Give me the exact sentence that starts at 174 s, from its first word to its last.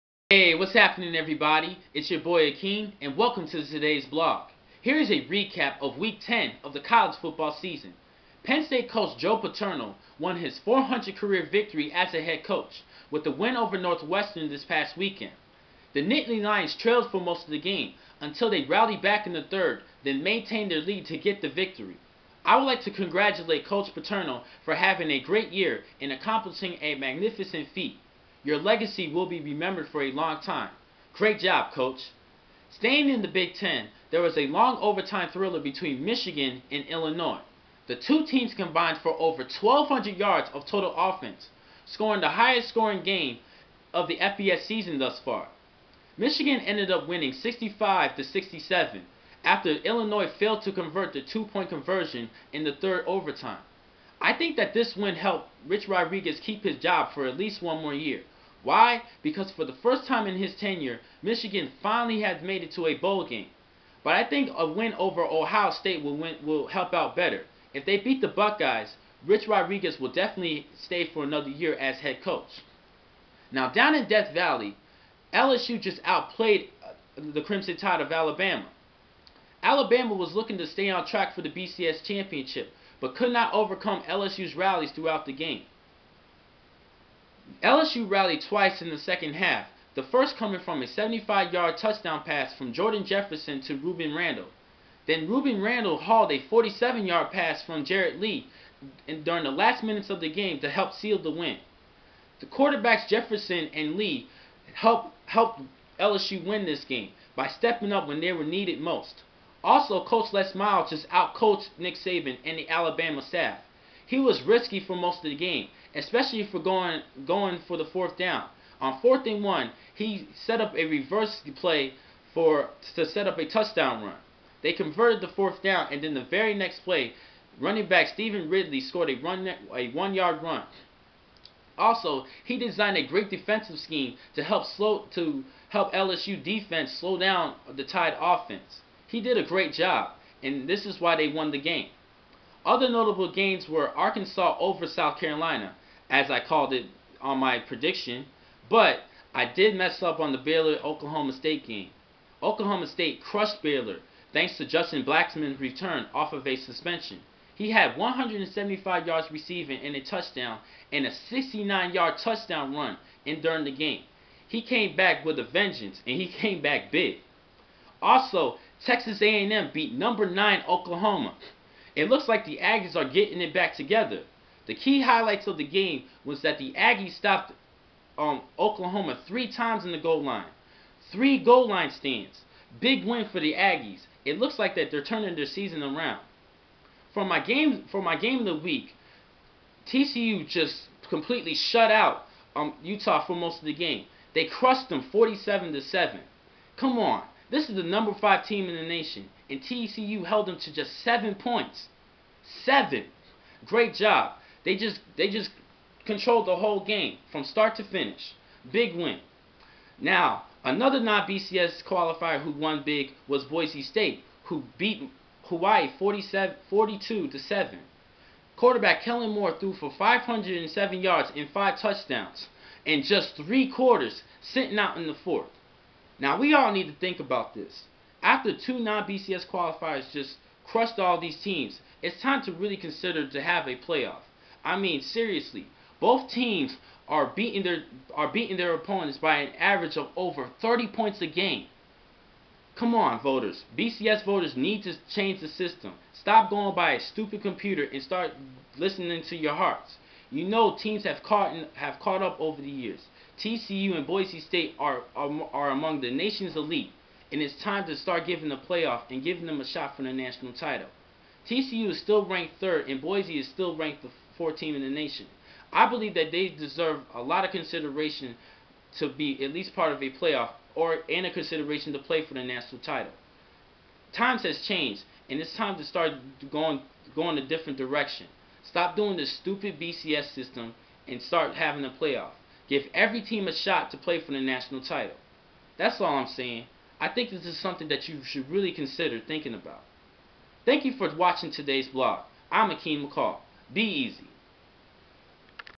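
The key highlights of the game was that the Aggies stopped um, Oklahoma three times in the goal line.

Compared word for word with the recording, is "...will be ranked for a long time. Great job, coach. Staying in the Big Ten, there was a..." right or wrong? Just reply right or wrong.
wrong.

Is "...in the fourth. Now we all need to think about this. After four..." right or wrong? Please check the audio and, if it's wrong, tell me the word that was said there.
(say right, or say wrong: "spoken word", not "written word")
wrong: "two", not "four".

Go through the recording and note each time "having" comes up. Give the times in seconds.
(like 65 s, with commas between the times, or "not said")
24 s, 281 s.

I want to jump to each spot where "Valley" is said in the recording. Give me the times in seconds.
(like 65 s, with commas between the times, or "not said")
74 s.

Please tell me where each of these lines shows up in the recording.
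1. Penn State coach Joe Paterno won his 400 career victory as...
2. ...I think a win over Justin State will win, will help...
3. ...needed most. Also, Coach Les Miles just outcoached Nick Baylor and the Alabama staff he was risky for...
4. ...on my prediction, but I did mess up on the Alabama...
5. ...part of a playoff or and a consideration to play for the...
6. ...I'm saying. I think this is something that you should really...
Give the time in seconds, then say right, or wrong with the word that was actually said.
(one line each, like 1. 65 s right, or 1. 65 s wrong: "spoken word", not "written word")
1. 8 s right
2. 64 s wrong: "Ohio", not "Justin"
3. 108 s wrong: "Saban", not "Baylor"
4. 147 s wrong: "Baylor", not "Alabama"
5. 269 s right
6. 286 s right.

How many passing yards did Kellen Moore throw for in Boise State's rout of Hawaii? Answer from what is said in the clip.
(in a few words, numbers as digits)
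507.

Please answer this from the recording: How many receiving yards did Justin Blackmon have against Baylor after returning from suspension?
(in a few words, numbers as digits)
175.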